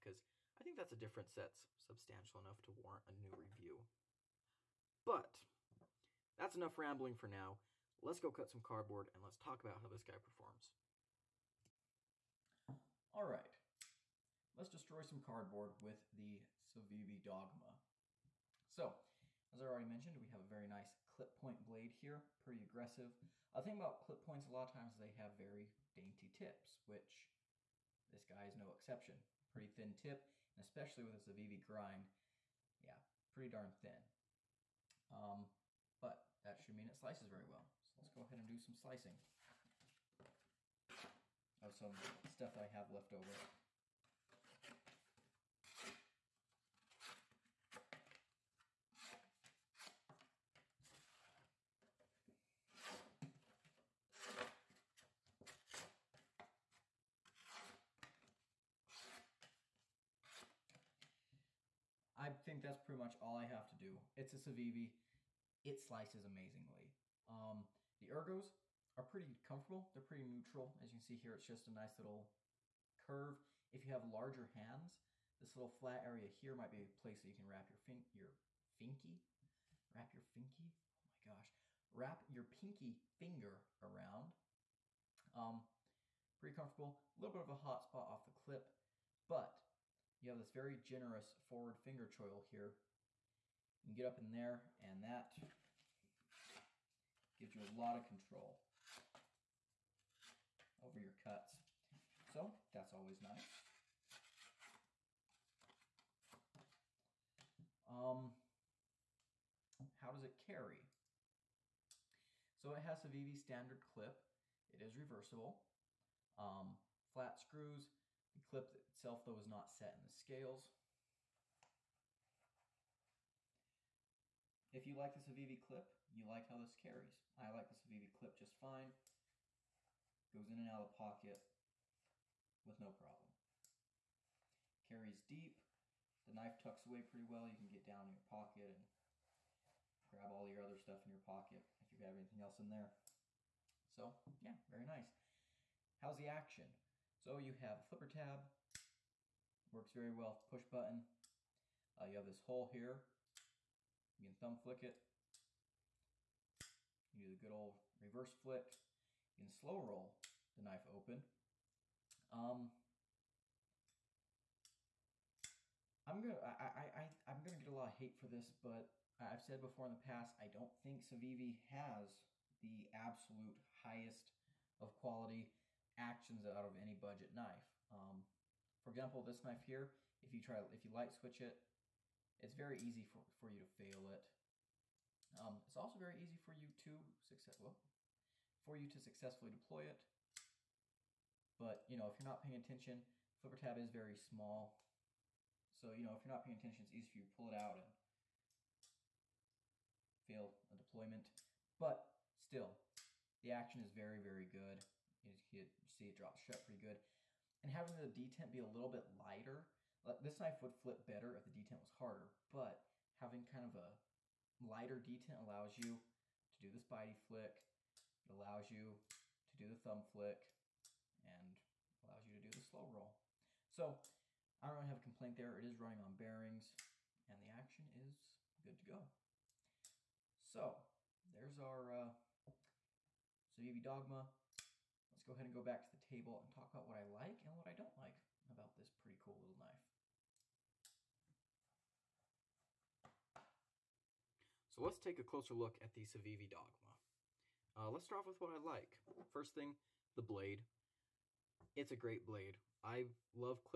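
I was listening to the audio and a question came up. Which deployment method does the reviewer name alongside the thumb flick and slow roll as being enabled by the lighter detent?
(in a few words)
Spidey flick.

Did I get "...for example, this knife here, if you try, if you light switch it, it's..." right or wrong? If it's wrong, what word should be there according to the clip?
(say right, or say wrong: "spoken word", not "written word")
right.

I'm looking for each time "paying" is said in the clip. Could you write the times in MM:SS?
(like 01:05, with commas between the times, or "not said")
03:12, 03:16.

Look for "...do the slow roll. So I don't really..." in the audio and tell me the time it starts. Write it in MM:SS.
03:42.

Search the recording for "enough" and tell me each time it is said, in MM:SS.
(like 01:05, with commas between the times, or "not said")
00:02, 00:06.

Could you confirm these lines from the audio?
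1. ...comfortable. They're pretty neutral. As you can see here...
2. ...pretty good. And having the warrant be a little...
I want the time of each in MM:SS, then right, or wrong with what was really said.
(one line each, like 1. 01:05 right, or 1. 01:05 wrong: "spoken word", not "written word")
1. 01:09 right
2. 03:26 wrong: "detent", not "warrant".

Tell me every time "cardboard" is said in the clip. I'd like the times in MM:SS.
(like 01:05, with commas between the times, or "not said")
00:08, 00:15.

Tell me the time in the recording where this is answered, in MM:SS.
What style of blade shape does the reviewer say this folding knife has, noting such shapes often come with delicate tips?
00:21.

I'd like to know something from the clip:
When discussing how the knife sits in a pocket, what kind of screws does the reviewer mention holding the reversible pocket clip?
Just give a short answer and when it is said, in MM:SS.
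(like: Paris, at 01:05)
Flat screws, at 01:57.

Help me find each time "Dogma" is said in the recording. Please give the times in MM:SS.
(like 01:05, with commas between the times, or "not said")
00:17, 03:53, 04:06.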